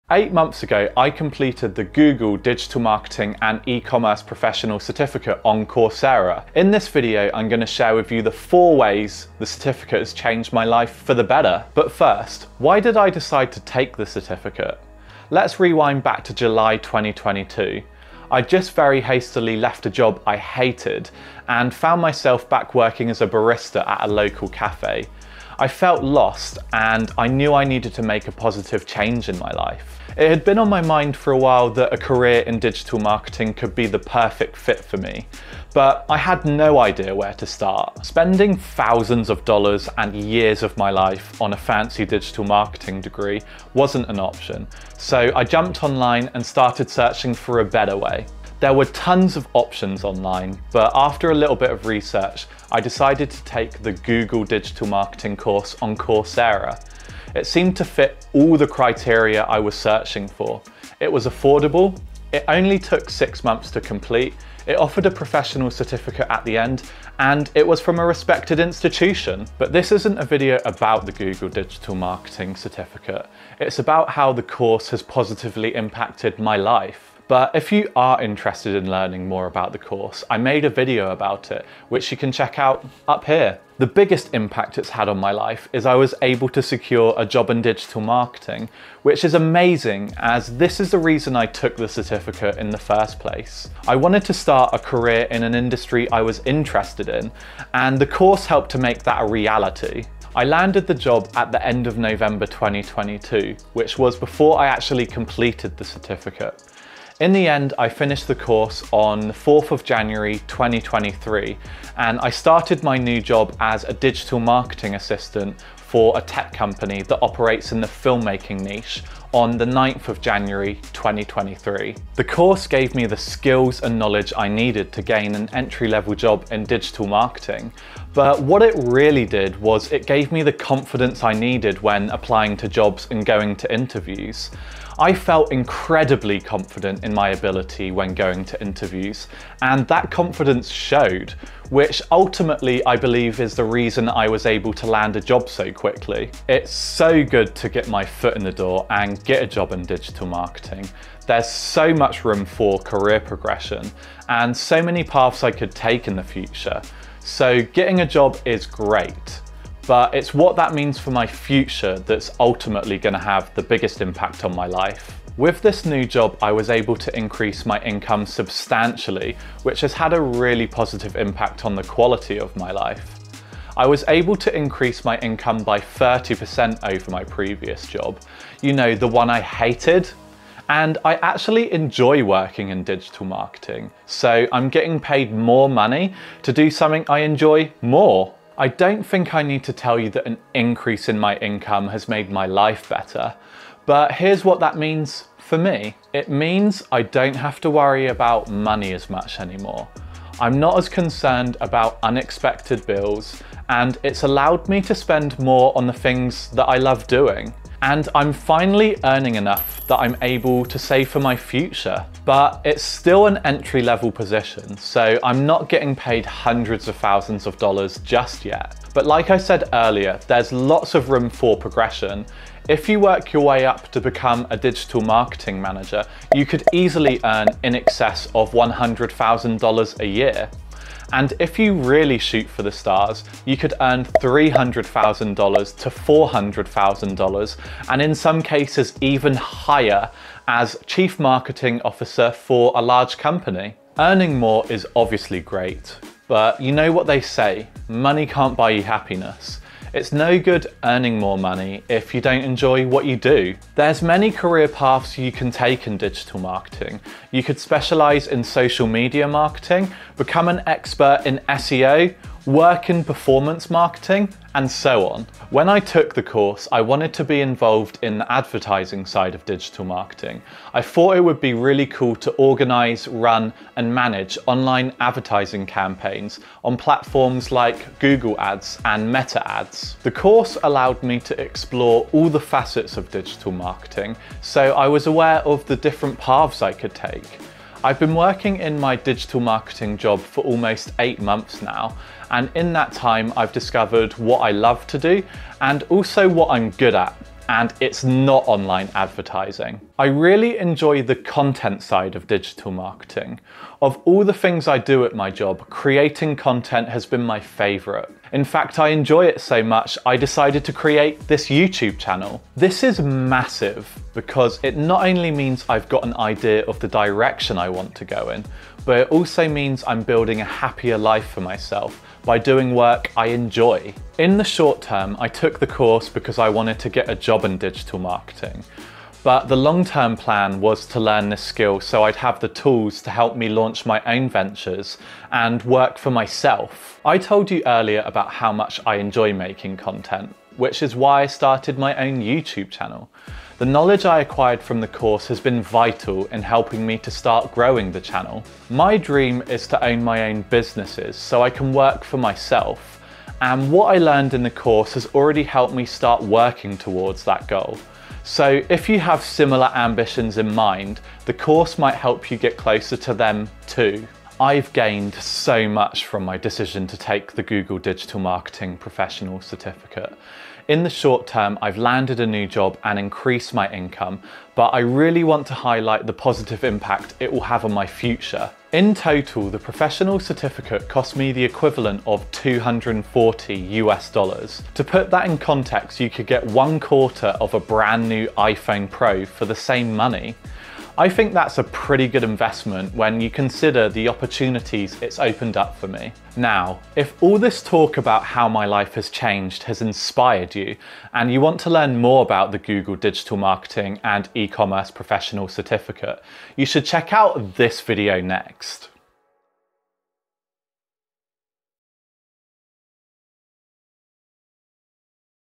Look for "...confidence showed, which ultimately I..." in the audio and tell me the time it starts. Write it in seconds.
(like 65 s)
140 s.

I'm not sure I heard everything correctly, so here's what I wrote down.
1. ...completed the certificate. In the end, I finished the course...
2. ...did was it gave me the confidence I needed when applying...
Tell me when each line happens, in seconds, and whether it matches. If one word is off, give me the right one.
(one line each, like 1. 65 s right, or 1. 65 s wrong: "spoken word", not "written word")
1. 105 s right
2. 129 s right.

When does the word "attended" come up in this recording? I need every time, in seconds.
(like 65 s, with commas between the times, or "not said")
not said.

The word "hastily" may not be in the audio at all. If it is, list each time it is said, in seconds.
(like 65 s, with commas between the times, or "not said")
18 s.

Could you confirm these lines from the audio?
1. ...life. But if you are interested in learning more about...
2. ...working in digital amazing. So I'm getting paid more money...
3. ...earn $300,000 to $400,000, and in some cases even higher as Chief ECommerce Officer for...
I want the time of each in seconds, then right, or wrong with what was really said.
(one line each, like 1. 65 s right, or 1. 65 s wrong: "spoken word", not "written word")
1. 76 s right
2. 182 s wrong: "marketing", not "amazing"
3. 233 s wrong: "Marketing", not "ECommerce".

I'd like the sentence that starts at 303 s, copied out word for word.
Of all the things I do at my job, creating content has been my favourite.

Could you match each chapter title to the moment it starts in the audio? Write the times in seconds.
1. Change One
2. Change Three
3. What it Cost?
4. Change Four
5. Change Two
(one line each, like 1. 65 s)
1. 84 s
2. 243 s
3. 364 s
4. 324 s
5. 165 s.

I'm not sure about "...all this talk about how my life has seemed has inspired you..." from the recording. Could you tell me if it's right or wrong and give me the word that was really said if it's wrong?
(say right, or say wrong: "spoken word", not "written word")
wrong: "changed", not "seemed".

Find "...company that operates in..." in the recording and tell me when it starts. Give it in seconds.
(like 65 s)
116 s.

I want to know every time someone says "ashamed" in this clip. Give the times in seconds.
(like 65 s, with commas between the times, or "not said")
not said.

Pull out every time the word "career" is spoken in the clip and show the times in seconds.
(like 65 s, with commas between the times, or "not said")
31 s, 94 s, 152 s, 254 s.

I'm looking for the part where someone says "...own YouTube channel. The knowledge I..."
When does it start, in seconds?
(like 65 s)
341 s.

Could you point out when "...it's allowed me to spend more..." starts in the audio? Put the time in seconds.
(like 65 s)
204 s.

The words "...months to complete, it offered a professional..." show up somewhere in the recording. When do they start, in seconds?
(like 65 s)
63 s.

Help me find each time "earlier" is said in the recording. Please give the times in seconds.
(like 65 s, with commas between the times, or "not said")
219 s, 337 s.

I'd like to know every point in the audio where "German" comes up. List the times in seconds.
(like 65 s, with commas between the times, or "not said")
not said.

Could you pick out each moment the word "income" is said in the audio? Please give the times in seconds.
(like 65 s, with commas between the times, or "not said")
167 s, 175 s, 191 s, 373 s.